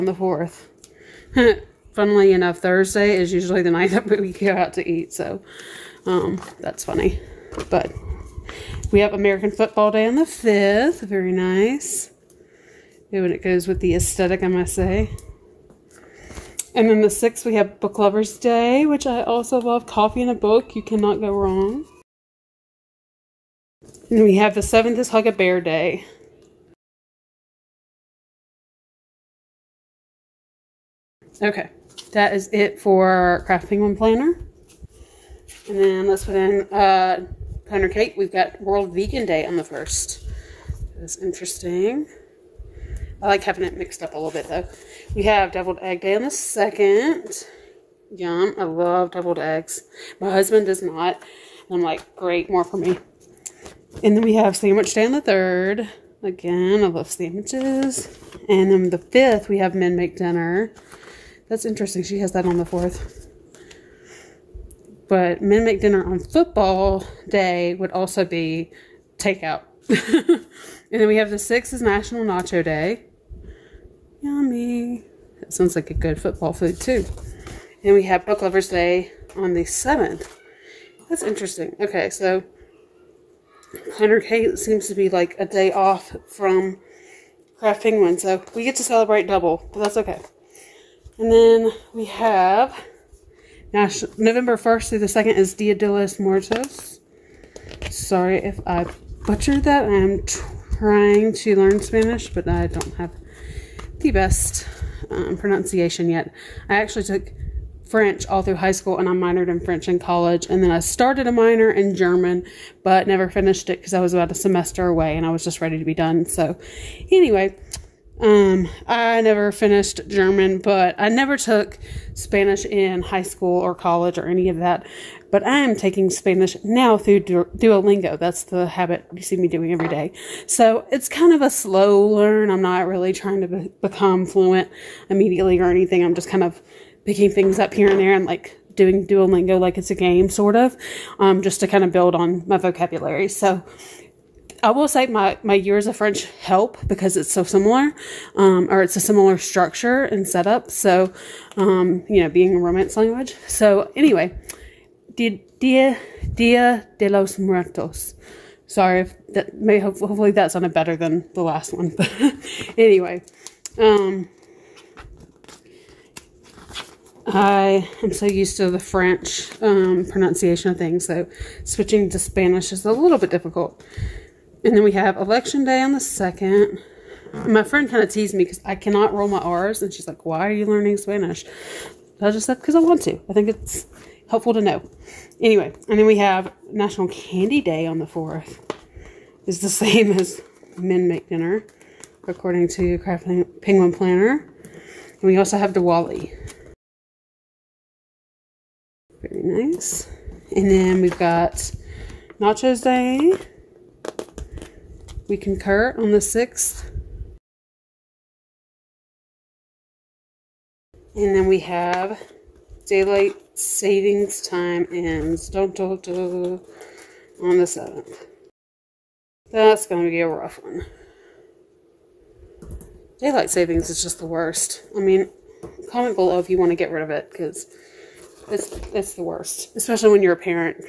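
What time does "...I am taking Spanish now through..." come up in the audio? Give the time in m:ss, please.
2:05.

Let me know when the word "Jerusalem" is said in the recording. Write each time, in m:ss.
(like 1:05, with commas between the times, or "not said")
not said.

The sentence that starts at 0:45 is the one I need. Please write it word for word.
We have deviled egg day on the second.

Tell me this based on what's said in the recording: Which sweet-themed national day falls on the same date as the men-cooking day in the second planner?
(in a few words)
National Candy Day.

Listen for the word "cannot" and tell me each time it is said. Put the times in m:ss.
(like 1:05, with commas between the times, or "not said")
0:20, 2:58.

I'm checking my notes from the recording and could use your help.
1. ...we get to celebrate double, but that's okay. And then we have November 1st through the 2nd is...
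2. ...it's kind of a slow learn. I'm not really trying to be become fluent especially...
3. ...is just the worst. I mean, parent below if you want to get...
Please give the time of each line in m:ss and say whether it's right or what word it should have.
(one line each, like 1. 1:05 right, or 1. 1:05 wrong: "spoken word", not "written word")
1. 1:28 right
2. 2:10 wrong: "immediately", not "especially"
3. 3:43 wrong: "comment", not "parent".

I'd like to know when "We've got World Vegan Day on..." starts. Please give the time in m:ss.
0:38.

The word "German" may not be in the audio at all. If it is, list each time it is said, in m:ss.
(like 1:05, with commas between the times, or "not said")
1:51, 2:00.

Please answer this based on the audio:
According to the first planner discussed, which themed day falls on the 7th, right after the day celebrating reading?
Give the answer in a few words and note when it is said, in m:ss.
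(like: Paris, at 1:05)
Hug a Bear Day, at 0:25.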